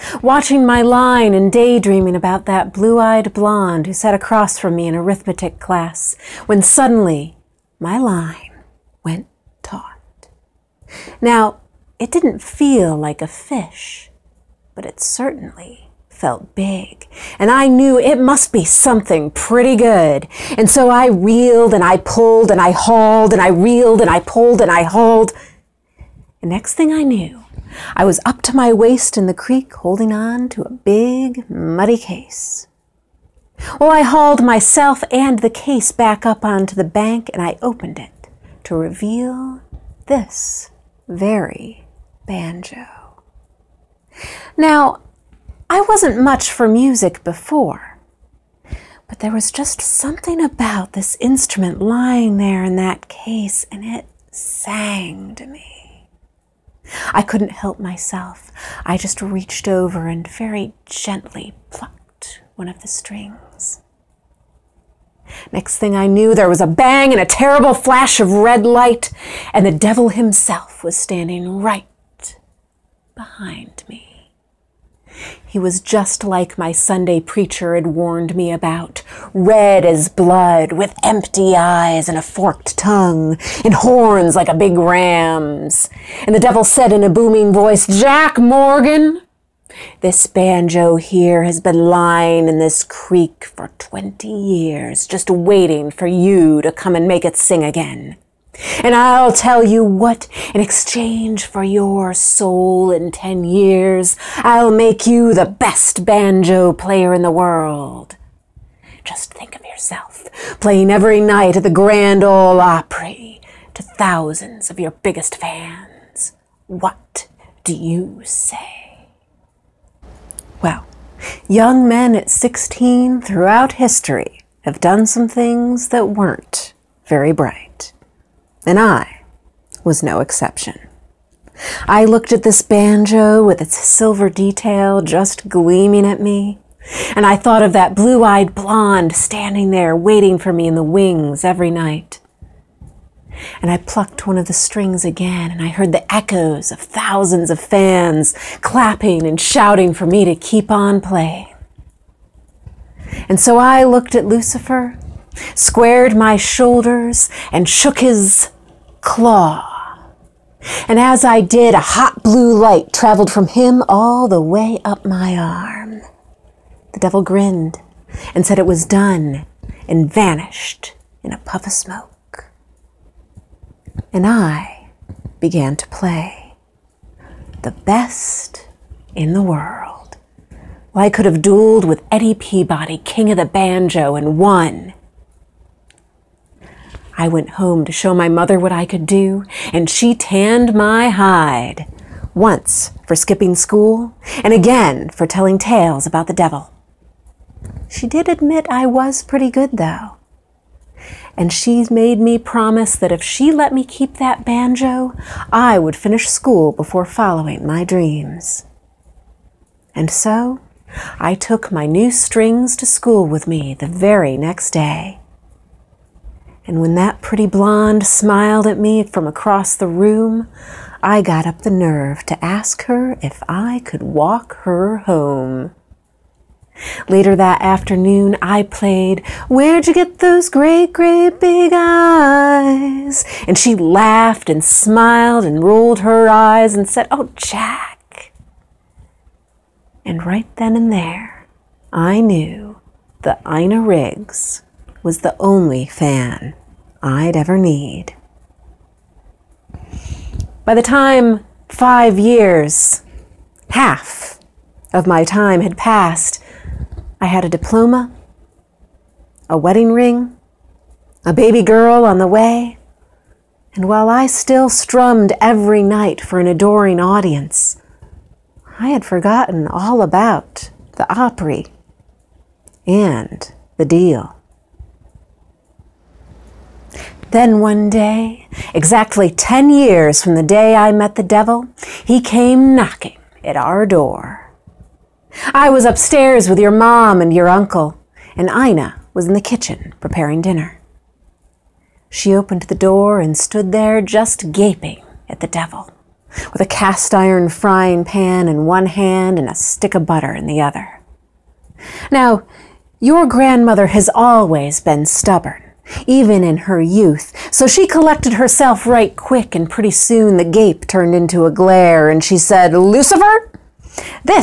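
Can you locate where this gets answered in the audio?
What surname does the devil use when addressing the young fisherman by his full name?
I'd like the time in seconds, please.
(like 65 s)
88 s.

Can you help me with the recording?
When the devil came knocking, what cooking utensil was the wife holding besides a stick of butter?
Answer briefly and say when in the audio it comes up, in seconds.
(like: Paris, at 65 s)
Cast iron frying pan, at 296 s.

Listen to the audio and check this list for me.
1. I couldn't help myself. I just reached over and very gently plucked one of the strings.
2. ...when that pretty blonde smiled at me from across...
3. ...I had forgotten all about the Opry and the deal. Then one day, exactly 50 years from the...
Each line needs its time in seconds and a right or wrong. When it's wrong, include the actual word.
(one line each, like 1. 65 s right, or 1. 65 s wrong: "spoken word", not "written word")
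1. 57 s right
2. 216 s right
3. 268 s wrong: "10", not "50".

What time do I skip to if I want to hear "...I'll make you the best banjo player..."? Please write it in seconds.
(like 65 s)
104 s.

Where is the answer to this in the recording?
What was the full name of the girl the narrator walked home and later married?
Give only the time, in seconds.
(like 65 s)
243 s.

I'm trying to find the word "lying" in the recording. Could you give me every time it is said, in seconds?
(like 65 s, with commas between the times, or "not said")
51 s, 91 s.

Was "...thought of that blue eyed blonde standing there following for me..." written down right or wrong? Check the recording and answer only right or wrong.
wrong.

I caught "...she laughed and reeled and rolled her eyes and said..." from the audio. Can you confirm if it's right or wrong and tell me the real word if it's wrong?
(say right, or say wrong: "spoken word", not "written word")
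wrong: "smiled", not "reeled".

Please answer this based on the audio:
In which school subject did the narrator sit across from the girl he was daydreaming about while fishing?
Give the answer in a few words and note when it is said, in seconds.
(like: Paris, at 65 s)
Arithmetic, at 4 s.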